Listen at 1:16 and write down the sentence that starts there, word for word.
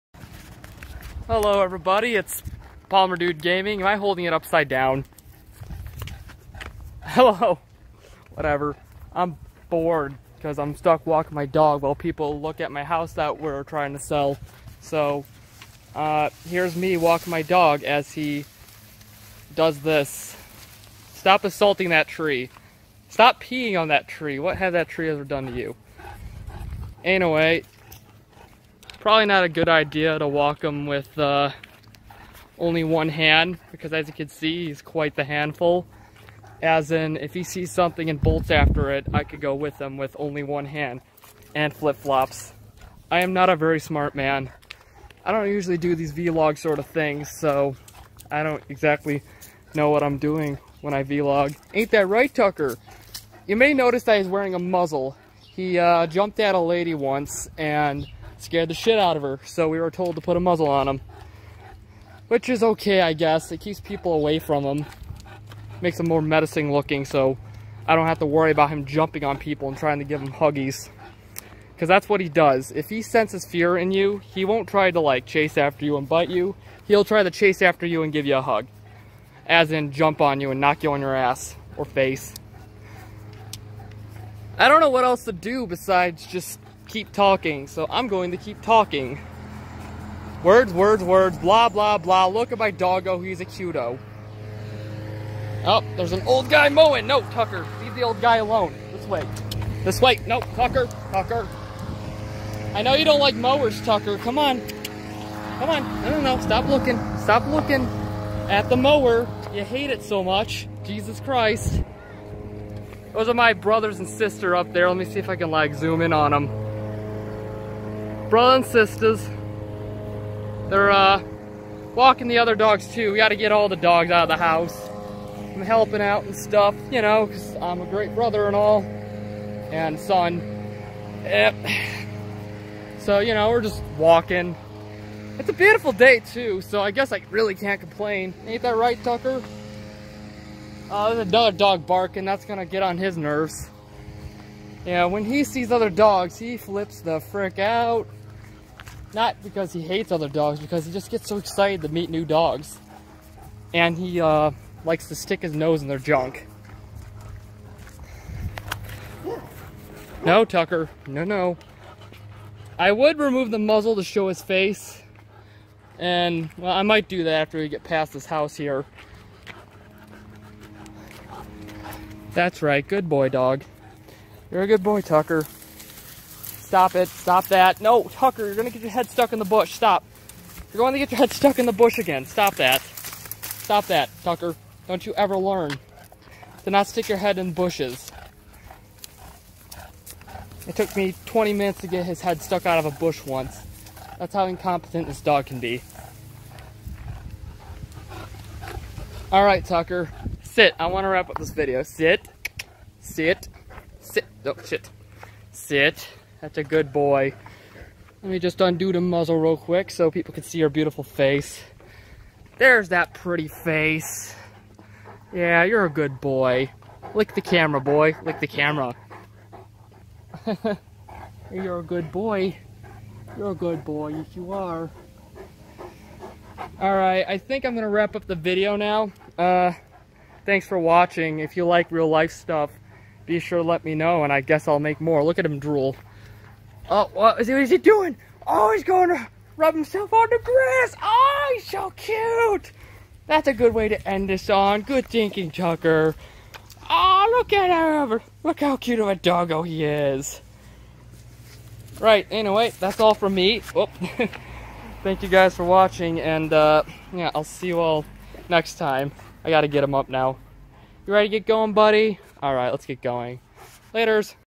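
He'll try to chase after you and give you a hug.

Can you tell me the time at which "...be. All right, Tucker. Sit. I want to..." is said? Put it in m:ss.
3:15.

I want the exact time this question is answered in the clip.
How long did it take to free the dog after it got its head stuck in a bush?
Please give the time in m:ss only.
3:11.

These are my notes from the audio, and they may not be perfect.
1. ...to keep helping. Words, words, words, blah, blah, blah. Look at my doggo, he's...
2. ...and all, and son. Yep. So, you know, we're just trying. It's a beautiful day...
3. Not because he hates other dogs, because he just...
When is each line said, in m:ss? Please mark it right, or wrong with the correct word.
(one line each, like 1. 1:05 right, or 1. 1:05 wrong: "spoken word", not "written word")
1. 1:28 wrong: "talking", not "helping"
2. 2:08 wrong: "walking", not "trying"
3. 2:29 right.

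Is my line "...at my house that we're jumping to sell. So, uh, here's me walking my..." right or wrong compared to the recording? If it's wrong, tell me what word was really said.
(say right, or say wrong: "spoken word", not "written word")
wrong: "trying", not "jumping".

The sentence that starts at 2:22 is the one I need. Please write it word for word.
That's gonna get on his nerves.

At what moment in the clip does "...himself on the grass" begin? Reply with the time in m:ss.
3:59.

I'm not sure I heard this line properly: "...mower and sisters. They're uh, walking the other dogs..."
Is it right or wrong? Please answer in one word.
wrong.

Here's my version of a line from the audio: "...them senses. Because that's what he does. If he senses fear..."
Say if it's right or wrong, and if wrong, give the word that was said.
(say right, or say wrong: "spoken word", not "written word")
wrong: "huggies", not "senses".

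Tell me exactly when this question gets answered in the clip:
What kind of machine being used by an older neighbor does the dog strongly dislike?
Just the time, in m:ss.
1:43.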